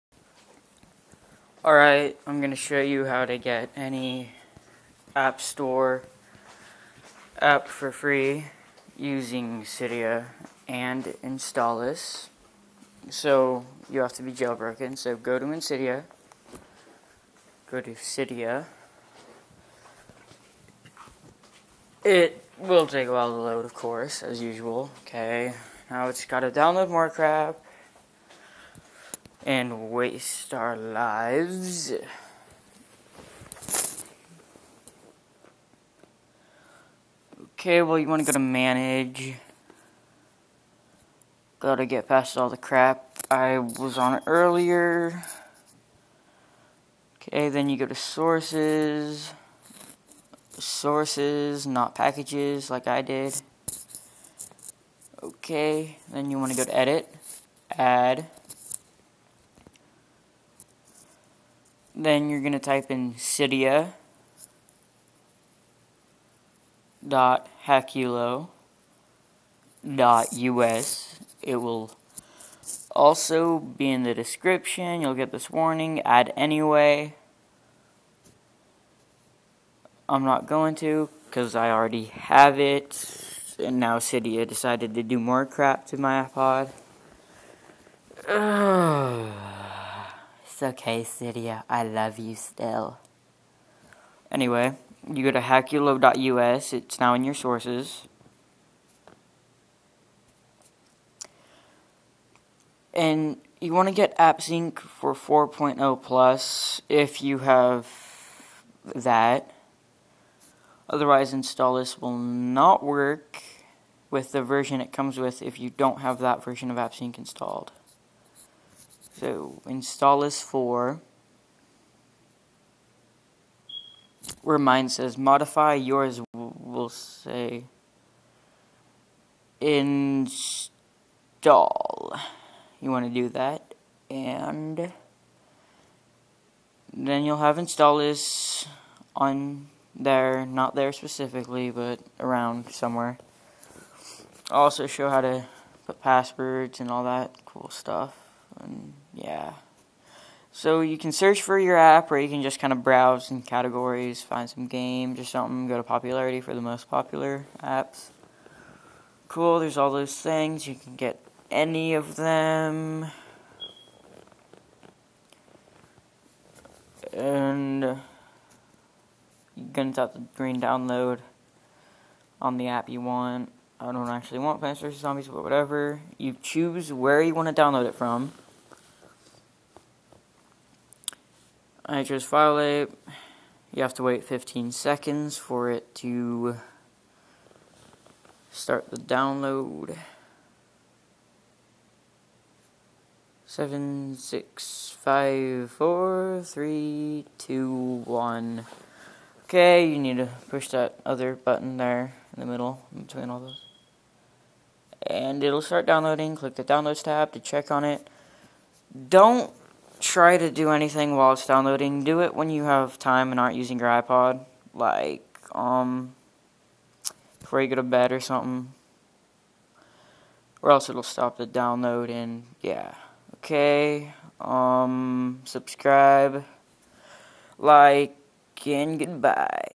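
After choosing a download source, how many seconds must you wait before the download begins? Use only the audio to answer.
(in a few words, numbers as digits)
15.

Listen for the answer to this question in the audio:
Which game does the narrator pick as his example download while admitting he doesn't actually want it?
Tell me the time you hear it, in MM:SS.
02:54.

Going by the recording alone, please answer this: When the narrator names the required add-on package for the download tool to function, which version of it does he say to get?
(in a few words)
4.0 plus.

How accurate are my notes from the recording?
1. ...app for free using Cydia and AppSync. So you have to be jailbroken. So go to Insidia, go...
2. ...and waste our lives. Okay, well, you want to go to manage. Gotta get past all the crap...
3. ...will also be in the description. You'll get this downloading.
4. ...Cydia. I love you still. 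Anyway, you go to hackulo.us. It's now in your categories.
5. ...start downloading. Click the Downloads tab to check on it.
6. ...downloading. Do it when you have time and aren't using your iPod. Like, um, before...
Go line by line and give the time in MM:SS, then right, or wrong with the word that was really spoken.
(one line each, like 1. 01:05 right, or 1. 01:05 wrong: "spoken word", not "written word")
1. 00:07 wrong: "Installous", not "AppSync"
2. 00:29 right
3. 01:11 wrong: "warning", not "downloading"
4. 01:31 wrong: "sources", not "categories"
5. 03:25 right
6. 03:31 right.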